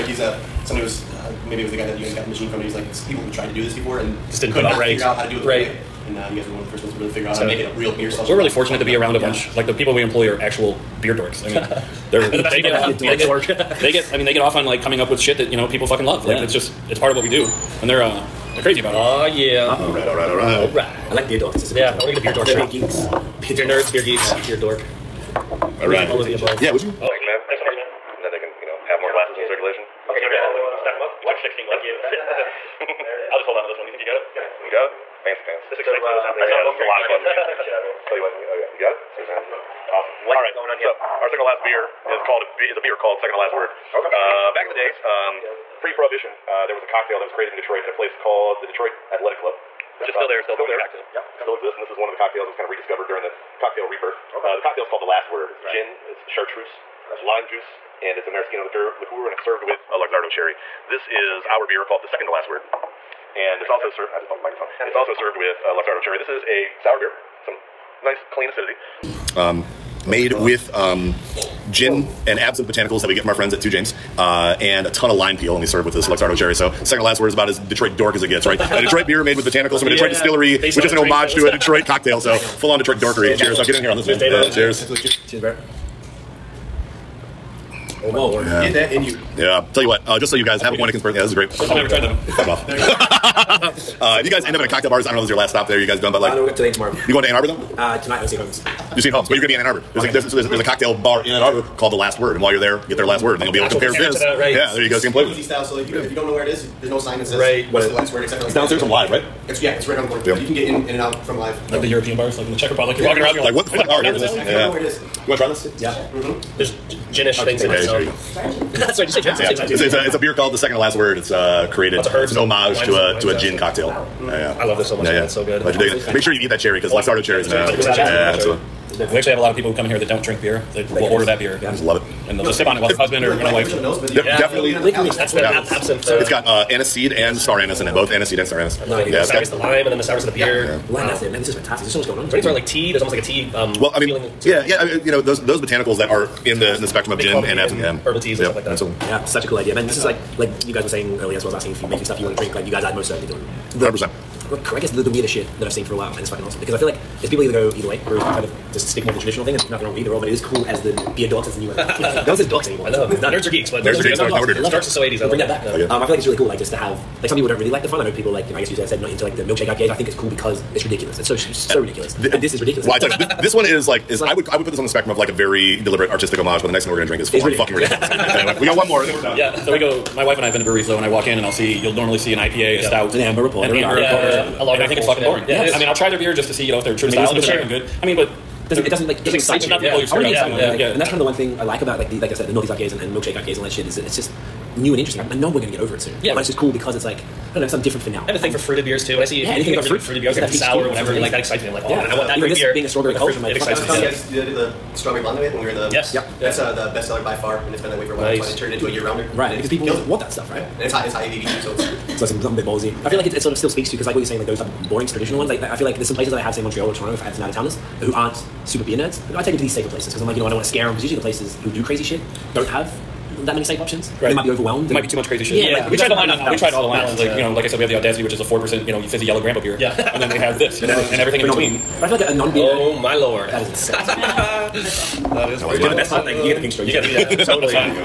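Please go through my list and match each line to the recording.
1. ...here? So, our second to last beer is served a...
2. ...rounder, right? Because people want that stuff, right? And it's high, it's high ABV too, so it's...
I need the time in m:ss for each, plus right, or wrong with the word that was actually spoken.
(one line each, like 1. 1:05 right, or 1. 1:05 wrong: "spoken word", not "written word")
1. 0:40 wrong: "called", not "served"
2. 3:29 right.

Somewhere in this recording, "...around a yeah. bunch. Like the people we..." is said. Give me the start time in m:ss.
0:08.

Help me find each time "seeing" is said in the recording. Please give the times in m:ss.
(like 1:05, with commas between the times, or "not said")
1:39.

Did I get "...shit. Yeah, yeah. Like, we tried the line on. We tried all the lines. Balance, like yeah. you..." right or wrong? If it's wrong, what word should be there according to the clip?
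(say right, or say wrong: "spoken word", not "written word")
right.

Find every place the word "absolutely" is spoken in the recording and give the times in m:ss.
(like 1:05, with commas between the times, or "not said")
2:08, 2:28.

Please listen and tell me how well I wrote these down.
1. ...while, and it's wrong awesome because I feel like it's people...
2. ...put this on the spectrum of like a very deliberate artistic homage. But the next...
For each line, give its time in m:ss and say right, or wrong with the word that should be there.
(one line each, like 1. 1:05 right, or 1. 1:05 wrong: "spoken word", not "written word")
1. 2:35 wrong: "fucking", not "wrong"
2. 2:54 right.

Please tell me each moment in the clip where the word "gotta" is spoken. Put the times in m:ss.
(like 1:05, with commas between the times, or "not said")
not said.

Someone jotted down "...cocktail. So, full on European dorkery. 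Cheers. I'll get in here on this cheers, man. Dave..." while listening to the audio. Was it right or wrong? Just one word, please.
wrong.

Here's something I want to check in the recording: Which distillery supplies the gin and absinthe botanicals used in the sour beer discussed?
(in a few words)
Two James.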